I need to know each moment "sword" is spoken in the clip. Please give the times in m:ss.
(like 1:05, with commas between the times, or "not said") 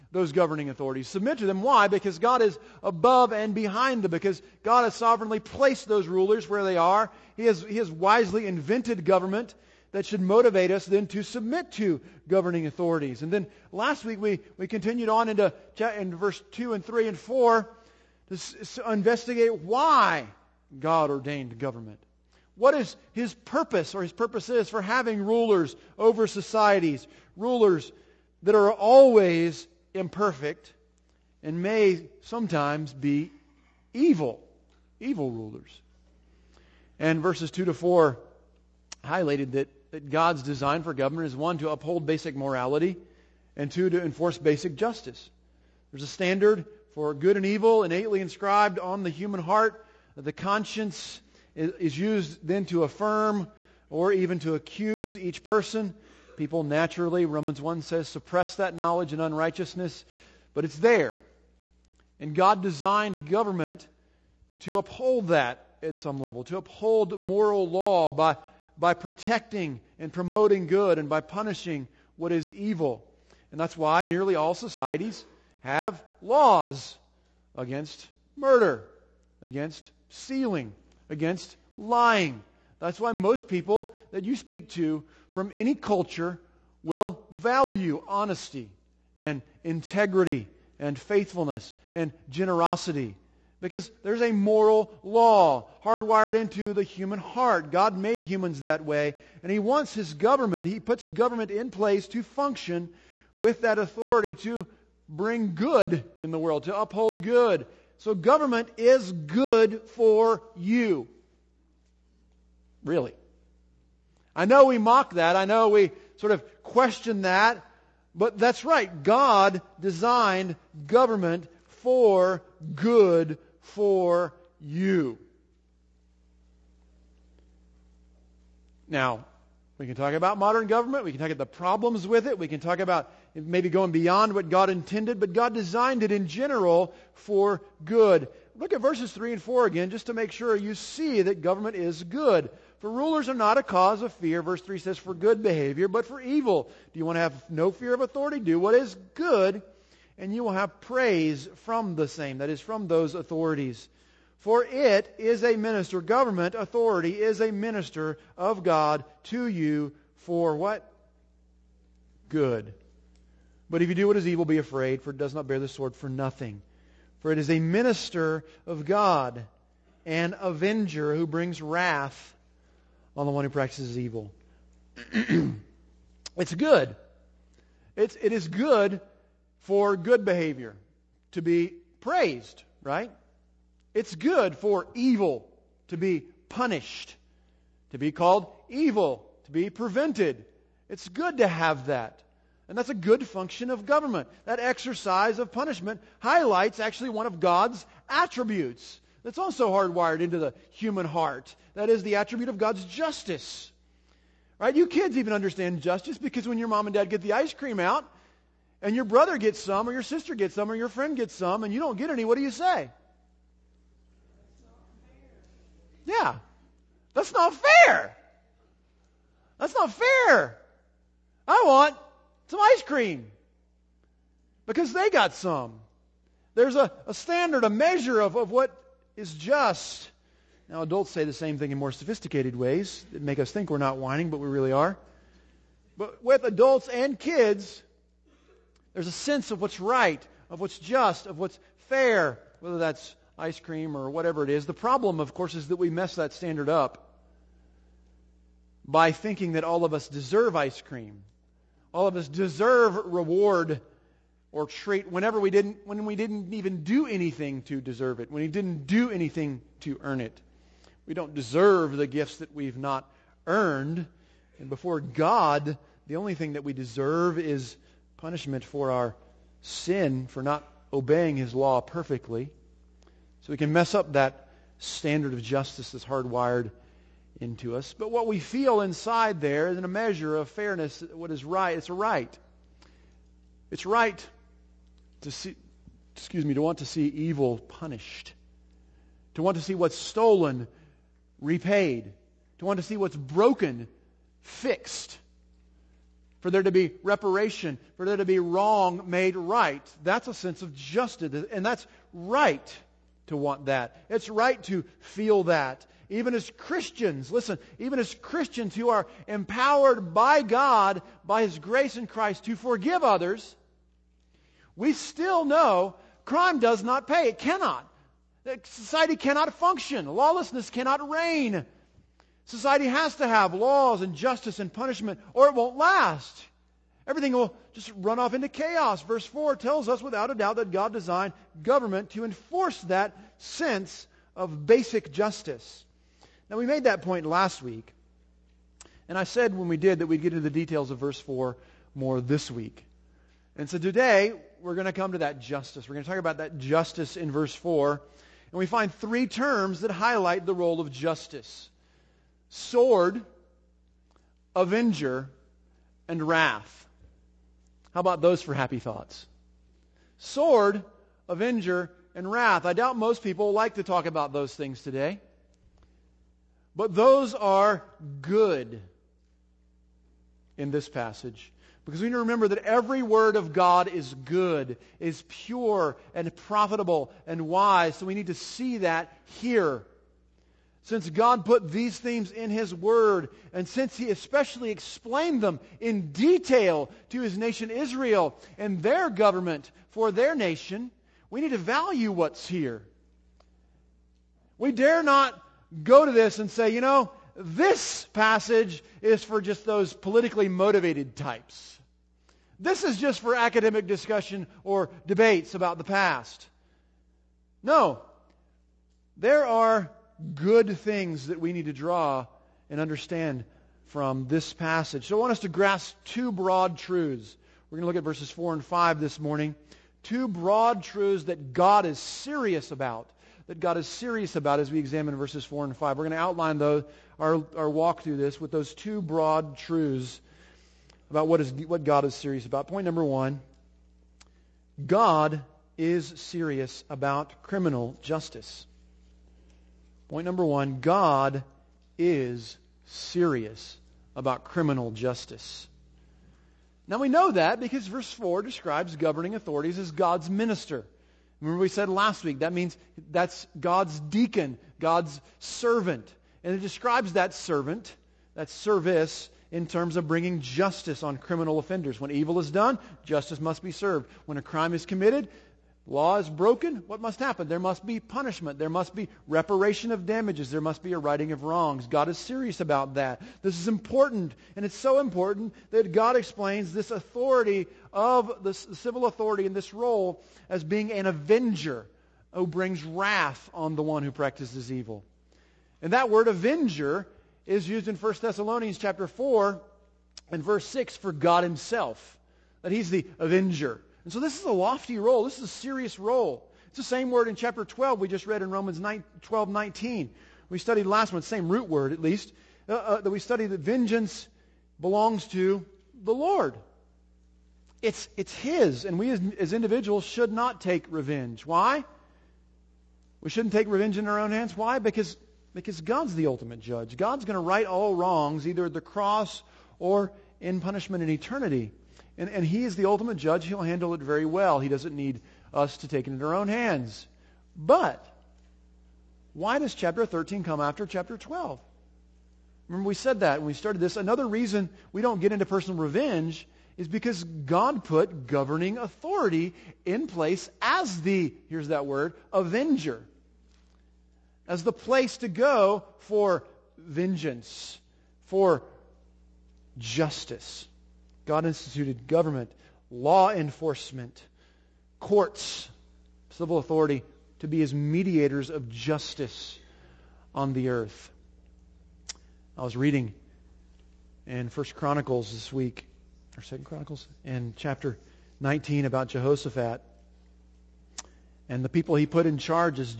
2:45, 5:52, 6:00.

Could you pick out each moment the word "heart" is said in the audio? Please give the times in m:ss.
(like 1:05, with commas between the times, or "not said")
0:49, 1:37, 3:21.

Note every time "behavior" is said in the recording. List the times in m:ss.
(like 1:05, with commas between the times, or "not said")
2:25, 3:00.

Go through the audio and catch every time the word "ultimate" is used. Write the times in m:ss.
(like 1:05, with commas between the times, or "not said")
8:36, 8:42.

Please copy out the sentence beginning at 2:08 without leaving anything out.
Now, we can talk about modern government.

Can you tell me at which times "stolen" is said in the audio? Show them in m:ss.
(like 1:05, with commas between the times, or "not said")
4:49.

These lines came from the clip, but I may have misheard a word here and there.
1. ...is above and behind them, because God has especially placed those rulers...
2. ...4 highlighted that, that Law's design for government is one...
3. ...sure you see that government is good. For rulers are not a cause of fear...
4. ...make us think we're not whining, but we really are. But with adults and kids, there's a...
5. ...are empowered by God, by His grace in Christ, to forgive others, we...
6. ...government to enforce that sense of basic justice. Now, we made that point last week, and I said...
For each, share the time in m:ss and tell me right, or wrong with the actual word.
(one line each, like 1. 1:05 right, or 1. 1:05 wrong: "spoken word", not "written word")
1. 0:02 wrong: "sovereignly", not "especially"
2. 0:37 wrong: "God", not "Law"
3. 2:20 right
4. 3:53 right
5. 5:08 right
6. 5:31 right.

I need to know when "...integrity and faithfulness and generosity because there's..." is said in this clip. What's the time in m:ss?
1:29.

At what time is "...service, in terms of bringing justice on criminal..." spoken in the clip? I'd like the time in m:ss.
7:38.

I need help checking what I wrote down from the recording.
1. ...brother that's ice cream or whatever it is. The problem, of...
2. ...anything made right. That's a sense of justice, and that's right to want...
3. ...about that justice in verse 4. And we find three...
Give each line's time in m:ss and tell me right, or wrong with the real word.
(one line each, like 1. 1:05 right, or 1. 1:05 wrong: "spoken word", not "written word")
1. 4:02 wrong: "whether", not "brother"
2. 4:58 wrong: "wrong", not "anything"
3. 5:46 right.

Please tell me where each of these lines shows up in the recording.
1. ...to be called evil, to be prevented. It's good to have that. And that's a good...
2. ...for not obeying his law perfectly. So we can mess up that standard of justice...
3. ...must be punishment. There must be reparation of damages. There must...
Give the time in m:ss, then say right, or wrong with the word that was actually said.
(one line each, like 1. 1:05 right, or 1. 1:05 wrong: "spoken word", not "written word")
1. 3:07 right
2. 4:30 right
3. 7:47 right.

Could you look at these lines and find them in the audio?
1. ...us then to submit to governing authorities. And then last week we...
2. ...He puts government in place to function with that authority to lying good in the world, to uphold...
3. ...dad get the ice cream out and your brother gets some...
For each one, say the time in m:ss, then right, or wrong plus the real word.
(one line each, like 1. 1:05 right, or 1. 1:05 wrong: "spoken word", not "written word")
1. 0:10 right
2. 1:40 wrong: "bring", not "lying"
3. 3:26 right.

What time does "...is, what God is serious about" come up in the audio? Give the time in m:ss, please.
7:11.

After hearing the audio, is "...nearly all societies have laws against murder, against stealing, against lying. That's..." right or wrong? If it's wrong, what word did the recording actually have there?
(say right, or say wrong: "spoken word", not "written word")
right.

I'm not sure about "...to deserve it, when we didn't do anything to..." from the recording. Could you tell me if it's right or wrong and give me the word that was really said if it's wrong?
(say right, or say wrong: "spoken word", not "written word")
right.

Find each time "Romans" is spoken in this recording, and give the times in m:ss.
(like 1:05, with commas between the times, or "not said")
0:57, 8:18.